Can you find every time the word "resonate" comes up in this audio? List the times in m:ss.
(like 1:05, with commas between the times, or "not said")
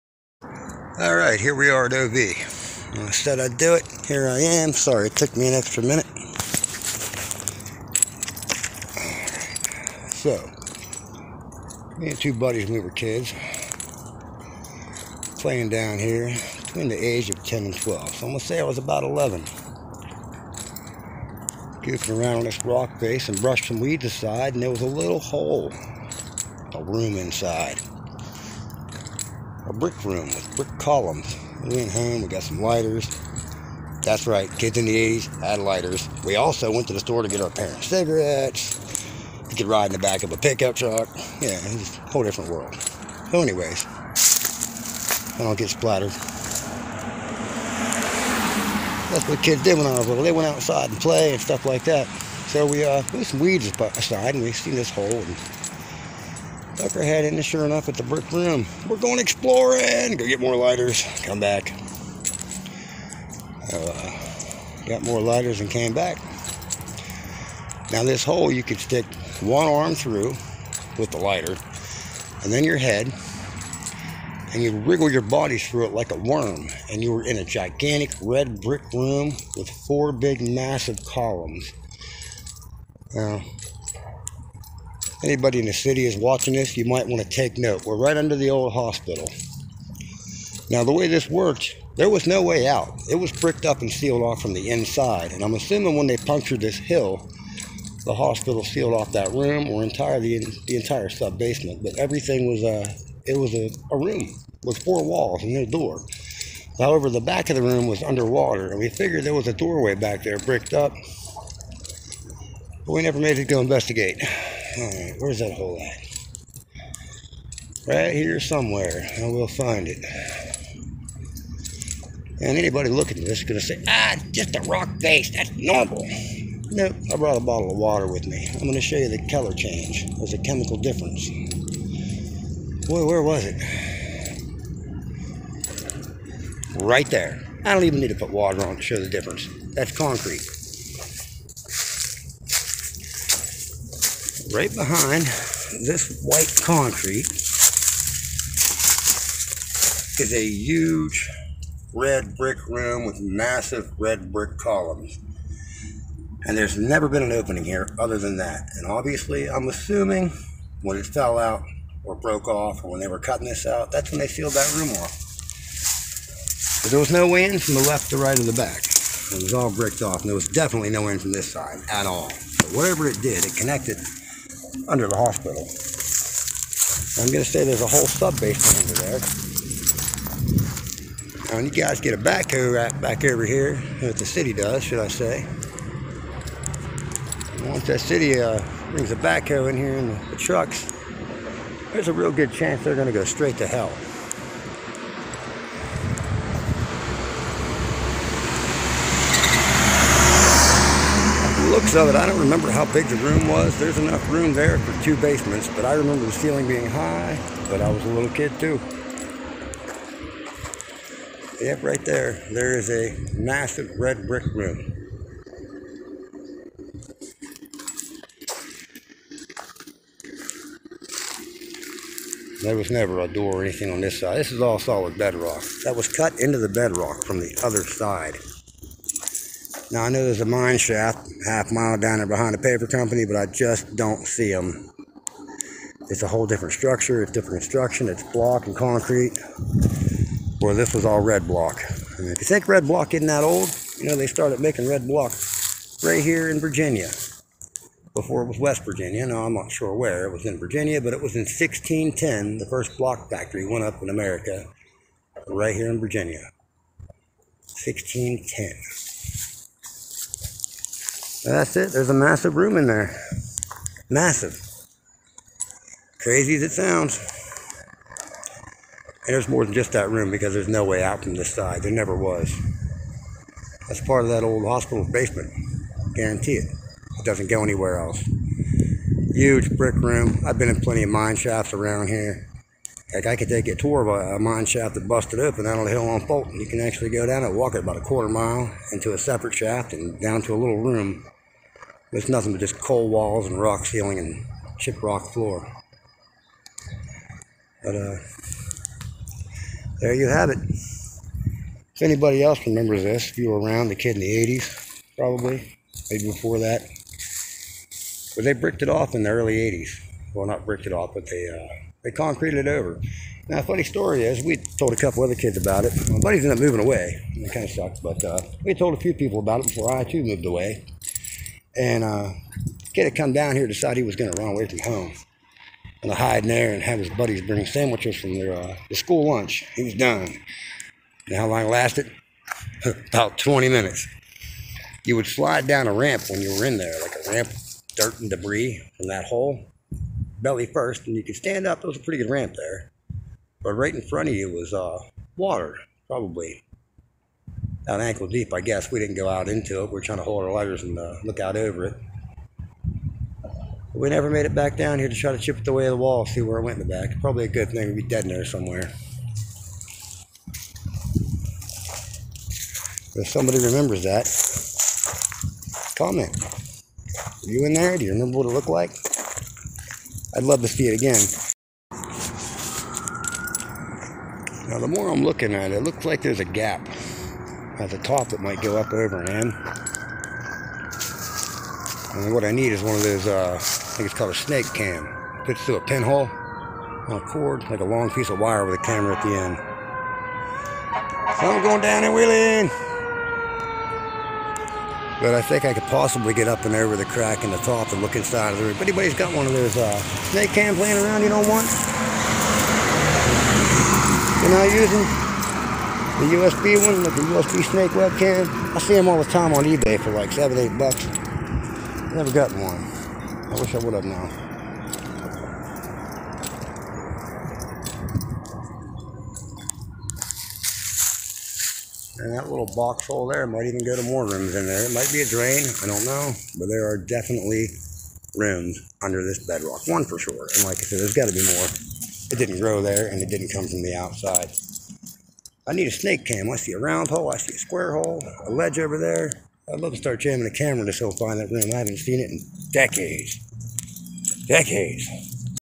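not said.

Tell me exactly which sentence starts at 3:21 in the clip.
So that I don't remember how big the room was.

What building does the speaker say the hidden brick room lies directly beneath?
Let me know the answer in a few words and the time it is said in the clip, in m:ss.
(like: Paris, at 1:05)
the old hospital, at 1:28.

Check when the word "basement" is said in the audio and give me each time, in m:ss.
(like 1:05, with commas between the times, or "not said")
1:41, 2:58, 3:25, 4:35.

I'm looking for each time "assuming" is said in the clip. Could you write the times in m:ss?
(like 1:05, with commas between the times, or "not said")
1:35, 2:39.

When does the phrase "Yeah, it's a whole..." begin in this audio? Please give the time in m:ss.
0:41.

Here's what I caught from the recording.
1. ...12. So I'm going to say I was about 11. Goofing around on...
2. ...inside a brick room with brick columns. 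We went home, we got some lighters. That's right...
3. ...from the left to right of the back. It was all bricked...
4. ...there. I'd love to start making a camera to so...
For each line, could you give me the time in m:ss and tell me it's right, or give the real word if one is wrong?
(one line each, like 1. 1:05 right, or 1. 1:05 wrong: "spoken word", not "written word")
1. 0:17 right
2. 0:27 right
3. 2:47 right
4. 7:18 wrong: "jamming", not "making".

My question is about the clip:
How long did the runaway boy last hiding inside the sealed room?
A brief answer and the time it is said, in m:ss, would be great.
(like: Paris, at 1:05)
About 20 minutes, at 5:33.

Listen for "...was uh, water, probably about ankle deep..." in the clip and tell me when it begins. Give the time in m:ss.
5:44.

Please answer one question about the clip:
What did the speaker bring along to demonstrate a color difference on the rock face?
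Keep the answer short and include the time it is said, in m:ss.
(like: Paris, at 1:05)
a bottle of water, at 2:07.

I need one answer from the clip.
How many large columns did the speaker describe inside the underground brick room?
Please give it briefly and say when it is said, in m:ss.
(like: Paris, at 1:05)
4, at 1:19.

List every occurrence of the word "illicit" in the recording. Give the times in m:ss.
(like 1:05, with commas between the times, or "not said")
not said.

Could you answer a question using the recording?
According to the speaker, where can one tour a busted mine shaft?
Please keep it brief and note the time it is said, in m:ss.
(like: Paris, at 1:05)
Fulton, at 4:46.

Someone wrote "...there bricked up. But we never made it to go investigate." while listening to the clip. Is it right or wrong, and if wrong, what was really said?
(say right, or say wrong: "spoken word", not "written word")
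right.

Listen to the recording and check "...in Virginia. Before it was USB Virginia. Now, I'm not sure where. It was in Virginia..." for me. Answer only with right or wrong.
wrong.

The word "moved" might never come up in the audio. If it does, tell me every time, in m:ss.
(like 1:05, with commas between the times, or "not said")
5:20.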